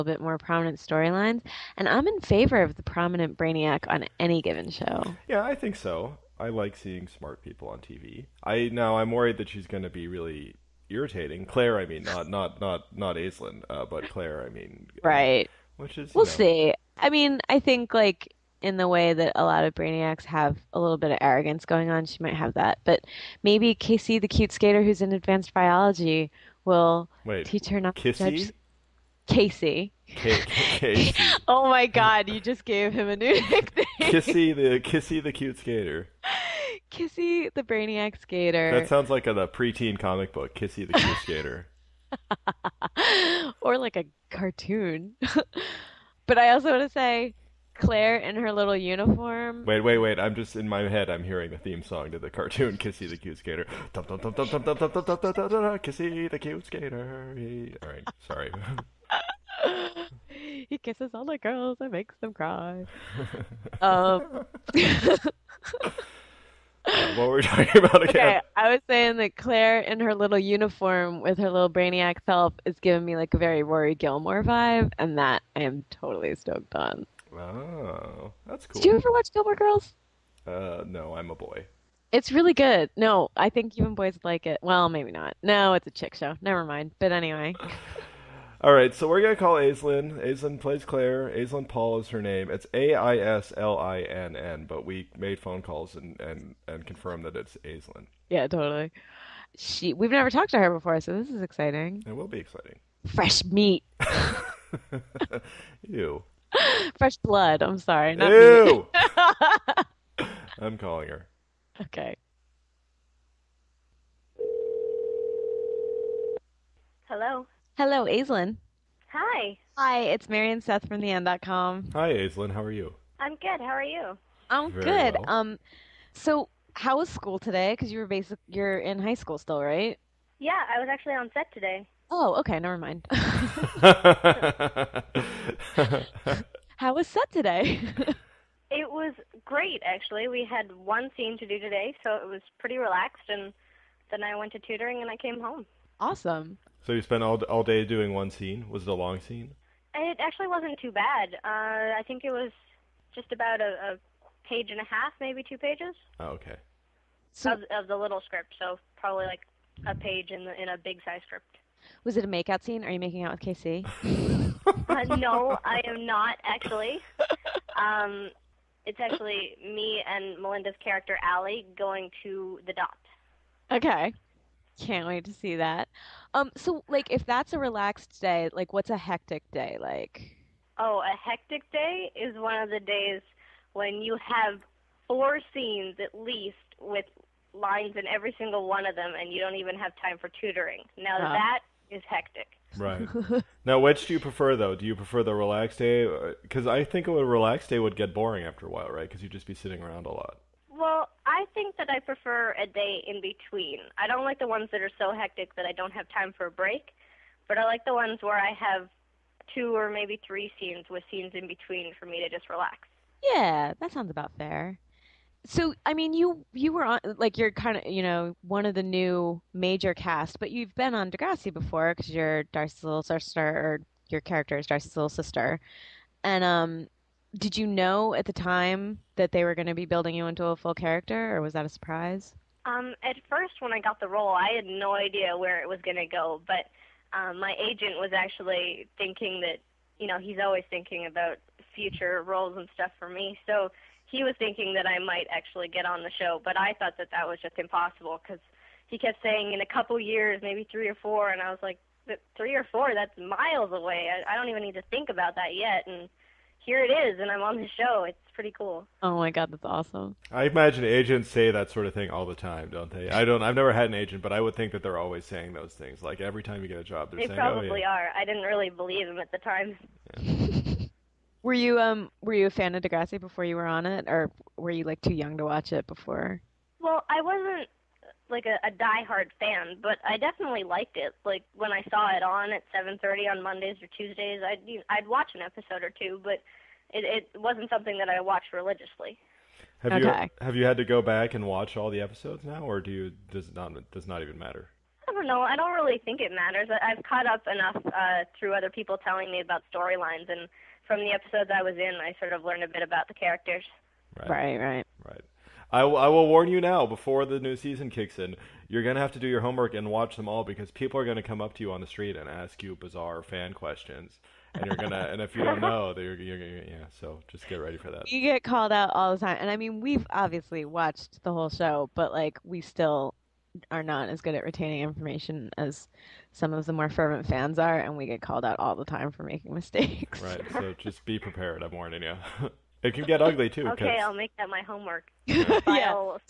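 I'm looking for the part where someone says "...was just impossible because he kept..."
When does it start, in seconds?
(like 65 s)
247 s.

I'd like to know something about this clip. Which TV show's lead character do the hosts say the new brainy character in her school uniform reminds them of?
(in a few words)
Rory Gilmore.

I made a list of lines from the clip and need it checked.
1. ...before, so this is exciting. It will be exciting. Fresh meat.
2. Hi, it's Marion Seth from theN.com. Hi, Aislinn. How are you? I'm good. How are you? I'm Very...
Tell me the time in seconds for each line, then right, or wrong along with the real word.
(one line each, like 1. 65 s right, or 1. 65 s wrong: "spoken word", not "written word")
1. 100 s right
2. 119 s right.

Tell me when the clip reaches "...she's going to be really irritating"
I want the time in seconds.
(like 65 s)
9 s.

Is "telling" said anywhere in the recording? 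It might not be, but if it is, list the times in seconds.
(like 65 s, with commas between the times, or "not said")
298 s.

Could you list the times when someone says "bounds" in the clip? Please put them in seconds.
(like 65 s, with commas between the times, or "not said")
not said.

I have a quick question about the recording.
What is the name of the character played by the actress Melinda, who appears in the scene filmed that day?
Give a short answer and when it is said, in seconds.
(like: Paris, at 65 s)
Alli, at 171 s.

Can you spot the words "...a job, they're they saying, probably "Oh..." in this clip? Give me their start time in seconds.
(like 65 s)
266 s.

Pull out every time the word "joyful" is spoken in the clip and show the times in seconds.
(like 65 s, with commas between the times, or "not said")
not said.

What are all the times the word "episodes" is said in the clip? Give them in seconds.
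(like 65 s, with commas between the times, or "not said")
285 s, 292 s, 301 s.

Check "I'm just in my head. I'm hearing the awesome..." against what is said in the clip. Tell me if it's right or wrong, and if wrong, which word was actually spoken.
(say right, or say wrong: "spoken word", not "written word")
wrong: "theme", not "awesome".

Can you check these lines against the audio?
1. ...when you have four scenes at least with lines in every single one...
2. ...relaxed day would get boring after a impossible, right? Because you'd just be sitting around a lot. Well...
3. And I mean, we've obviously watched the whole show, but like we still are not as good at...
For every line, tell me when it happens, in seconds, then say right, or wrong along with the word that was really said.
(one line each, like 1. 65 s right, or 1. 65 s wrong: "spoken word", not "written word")
1. 183 s right
2. 197 s wrong: "while", not "impossible"
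3. 319 s right.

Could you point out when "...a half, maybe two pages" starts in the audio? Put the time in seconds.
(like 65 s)
154 s.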